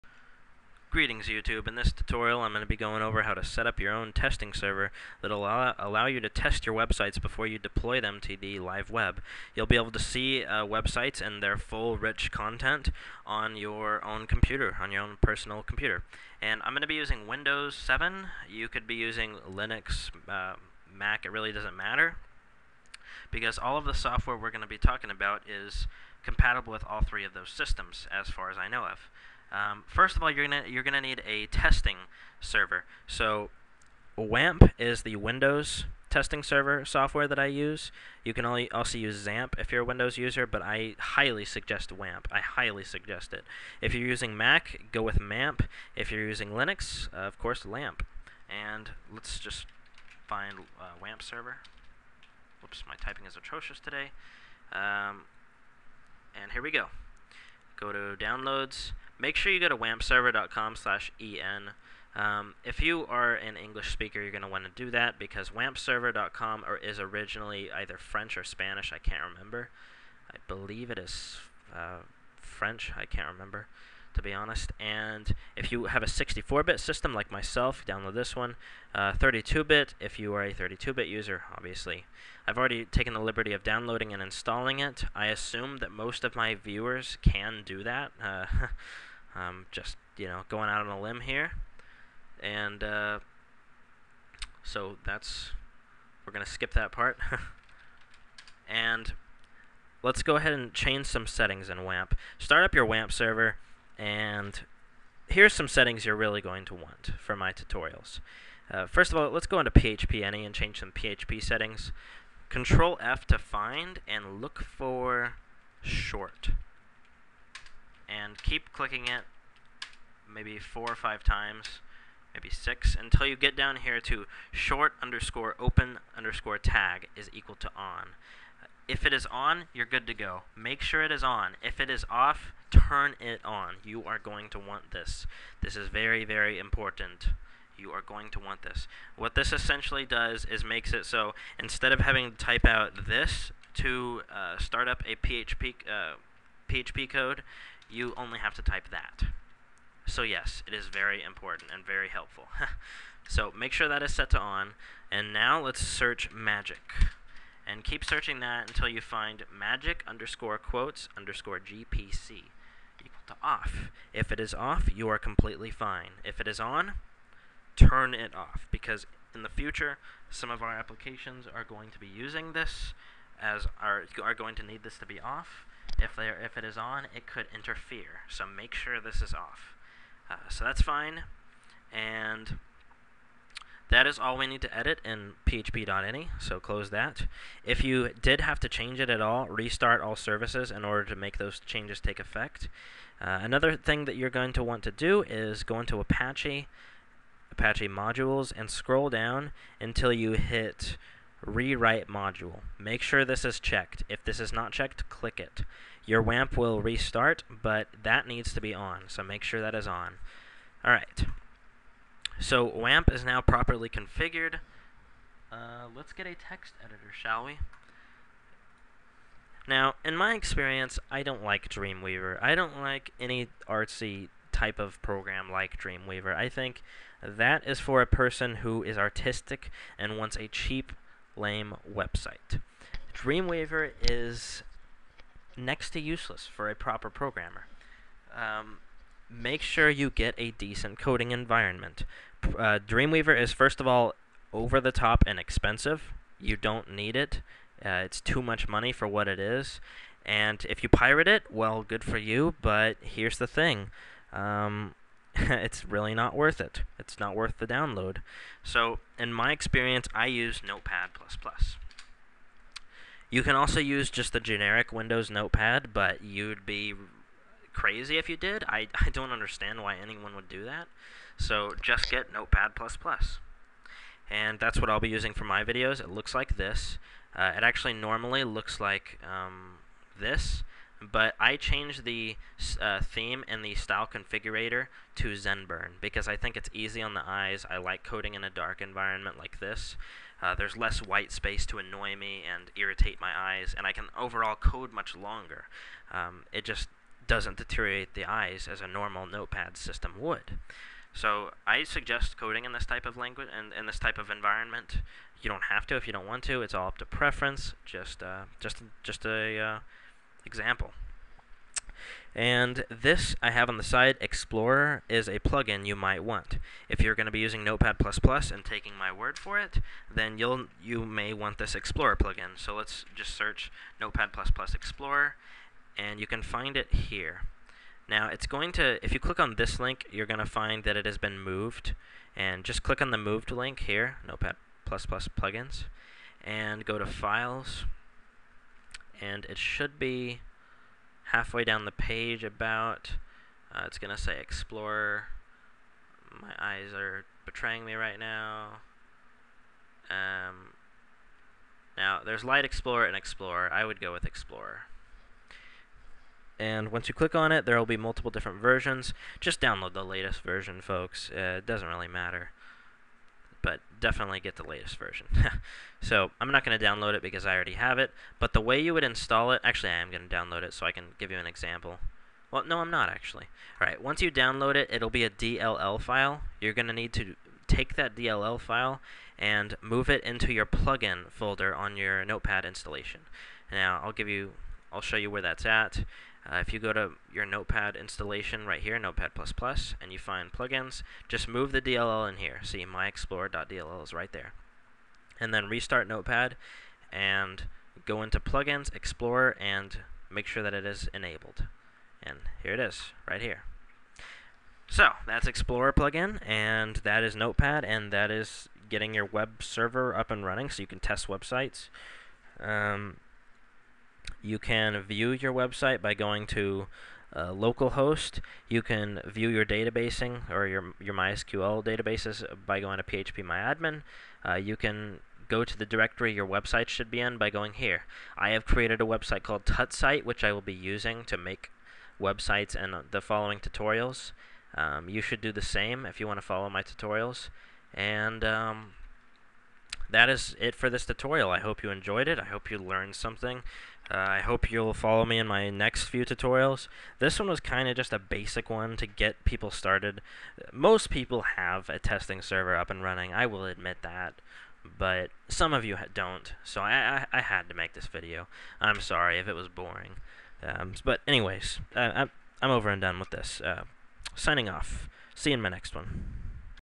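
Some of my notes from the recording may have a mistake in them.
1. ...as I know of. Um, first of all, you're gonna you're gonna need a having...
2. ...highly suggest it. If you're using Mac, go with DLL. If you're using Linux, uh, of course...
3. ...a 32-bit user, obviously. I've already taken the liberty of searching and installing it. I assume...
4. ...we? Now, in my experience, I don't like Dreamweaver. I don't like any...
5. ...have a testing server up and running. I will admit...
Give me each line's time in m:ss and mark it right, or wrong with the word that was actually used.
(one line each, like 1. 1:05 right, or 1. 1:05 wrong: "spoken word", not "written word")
1. 0:28 wrong: "testing", not "having"
2. 0:42 wrong: "MAMP", not "DLL"
3. 1:20 wrong: "downloading", not "searching"
4. 3:37 right
5. 7:31 right.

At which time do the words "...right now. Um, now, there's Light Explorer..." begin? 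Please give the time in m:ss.
5:47.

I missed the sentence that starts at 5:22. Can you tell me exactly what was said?
So let's just search Notepad++ Explorer, and you can find it here.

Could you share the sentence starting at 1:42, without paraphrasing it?
Start up your WAMP server, and here's some settings you're really going to want for my tutorials.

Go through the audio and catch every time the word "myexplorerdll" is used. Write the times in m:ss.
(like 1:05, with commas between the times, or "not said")
6:32.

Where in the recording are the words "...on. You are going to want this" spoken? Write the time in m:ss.
2:13.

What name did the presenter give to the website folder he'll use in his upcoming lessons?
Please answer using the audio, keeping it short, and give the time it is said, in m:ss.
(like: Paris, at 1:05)
TutSite, at 7:09.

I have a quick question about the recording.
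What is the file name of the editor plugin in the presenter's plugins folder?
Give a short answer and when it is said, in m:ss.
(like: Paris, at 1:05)
myexplorer.dll, at 6:32.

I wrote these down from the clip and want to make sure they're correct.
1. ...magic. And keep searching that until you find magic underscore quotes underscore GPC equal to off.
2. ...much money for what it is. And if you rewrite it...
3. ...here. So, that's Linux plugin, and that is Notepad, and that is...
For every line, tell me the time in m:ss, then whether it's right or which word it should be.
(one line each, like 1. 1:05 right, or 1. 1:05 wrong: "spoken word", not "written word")
1. 2:36 right
2. 4:08 wrong: "pirate", not "rewrite"
3. 6:43 wrong: "Explorer", not "Linux".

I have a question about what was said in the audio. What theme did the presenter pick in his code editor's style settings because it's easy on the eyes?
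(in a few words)
Zenburn.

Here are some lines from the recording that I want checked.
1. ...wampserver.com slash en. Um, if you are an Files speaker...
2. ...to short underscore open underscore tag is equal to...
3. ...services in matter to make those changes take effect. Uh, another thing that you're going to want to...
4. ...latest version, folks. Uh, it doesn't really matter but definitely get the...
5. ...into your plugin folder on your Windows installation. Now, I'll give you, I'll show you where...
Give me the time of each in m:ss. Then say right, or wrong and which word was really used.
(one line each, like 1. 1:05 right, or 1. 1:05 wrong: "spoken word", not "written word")
1. 0:59 wrong: "English", not "Files"
2. 2:04 right
3. 3:10 wrong: "order", not "matter"
4. 6:00 right
5. 6:20 wrong: "Notepad", not "Windows".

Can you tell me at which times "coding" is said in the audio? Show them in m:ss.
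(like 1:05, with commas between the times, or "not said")
4:00, 4:48, 5:02.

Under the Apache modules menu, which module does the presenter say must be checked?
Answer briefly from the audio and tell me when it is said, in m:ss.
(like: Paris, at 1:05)
rewrite module, at 3:21.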